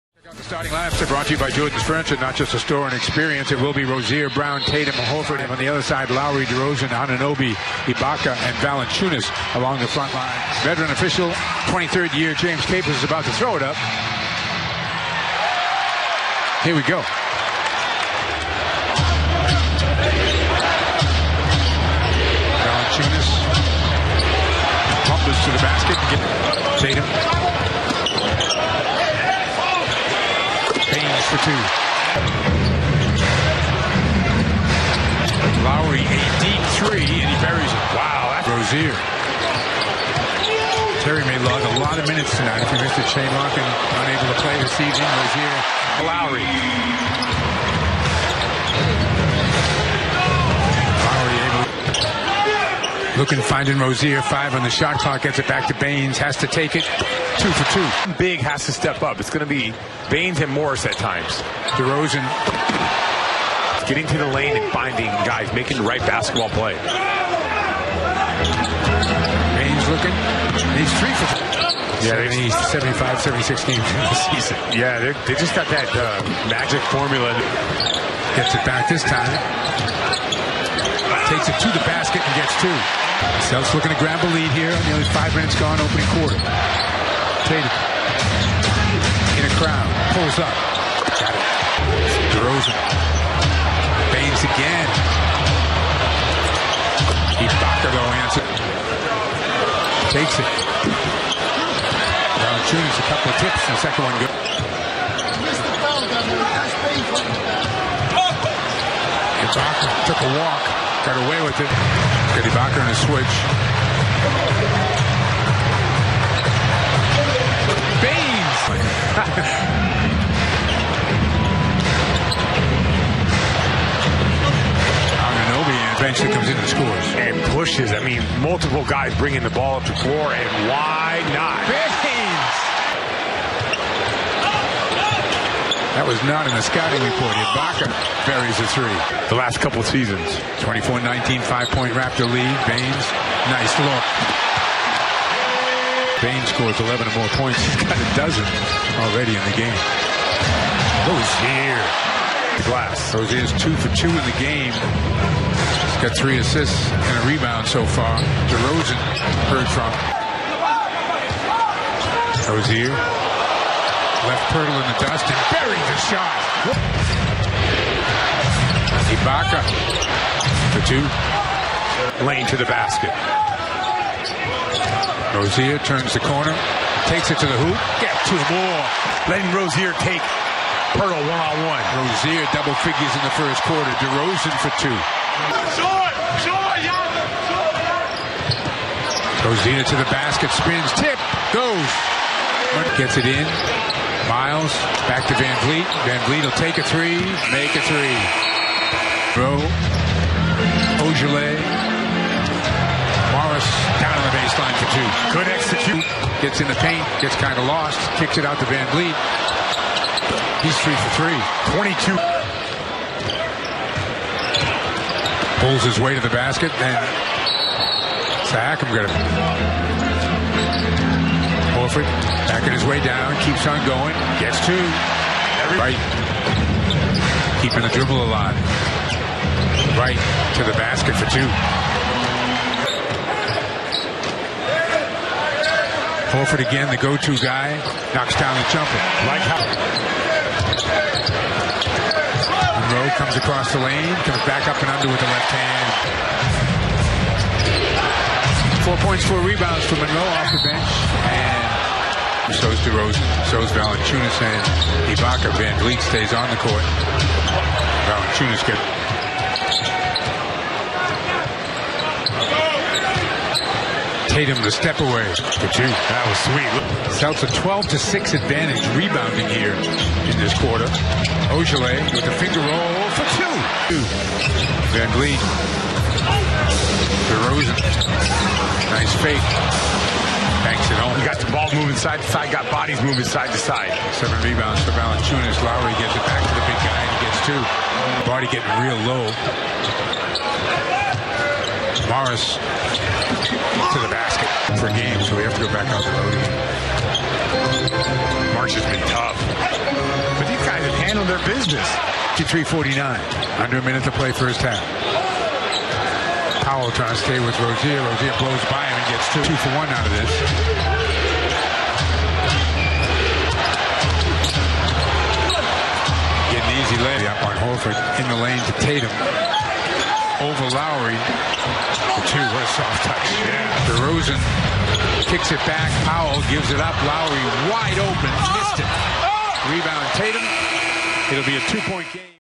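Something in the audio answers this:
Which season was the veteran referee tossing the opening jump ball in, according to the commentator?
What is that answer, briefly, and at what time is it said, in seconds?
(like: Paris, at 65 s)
23rd year, at 11 s.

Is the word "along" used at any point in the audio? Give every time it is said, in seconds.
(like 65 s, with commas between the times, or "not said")
9 s.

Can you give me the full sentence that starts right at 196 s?
Van Vliet will take a three, make a three.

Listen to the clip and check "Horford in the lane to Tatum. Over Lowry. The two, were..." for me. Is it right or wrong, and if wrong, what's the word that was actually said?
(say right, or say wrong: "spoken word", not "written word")
right.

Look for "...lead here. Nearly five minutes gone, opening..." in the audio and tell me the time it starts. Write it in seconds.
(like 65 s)
84 s.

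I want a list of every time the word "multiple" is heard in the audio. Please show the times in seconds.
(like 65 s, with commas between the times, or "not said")
128 s.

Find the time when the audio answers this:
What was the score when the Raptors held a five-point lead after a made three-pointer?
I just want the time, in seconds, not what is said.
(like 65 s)
140 s.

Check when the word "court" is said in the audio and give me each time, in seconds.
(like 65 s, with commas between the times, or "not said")
256 s.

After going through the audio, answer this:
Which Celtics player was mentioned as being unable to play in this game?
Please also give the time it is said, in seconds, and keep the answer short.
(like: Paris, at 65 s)
Shane Larkin, at 43 s.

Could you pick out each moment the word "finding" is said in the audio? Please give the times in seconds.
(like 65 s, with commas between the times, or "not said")
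53 s, 64 s.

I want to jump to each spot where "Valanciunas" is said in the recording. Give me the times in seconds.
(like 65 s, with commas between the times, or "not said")
8 s, 102 s, 253 s, 258 s, 284 s.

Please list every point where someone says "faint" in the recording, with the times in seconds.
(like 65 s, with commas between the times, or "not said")
not said.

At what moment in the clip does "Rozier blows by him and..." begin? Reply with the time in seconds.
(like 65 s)
308 s.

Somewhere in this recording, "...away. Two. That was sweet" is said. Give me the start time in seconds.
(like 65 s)
265 s.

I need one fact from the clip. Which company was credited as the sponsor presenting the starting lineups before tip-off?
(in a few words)
Jordan's Furniture.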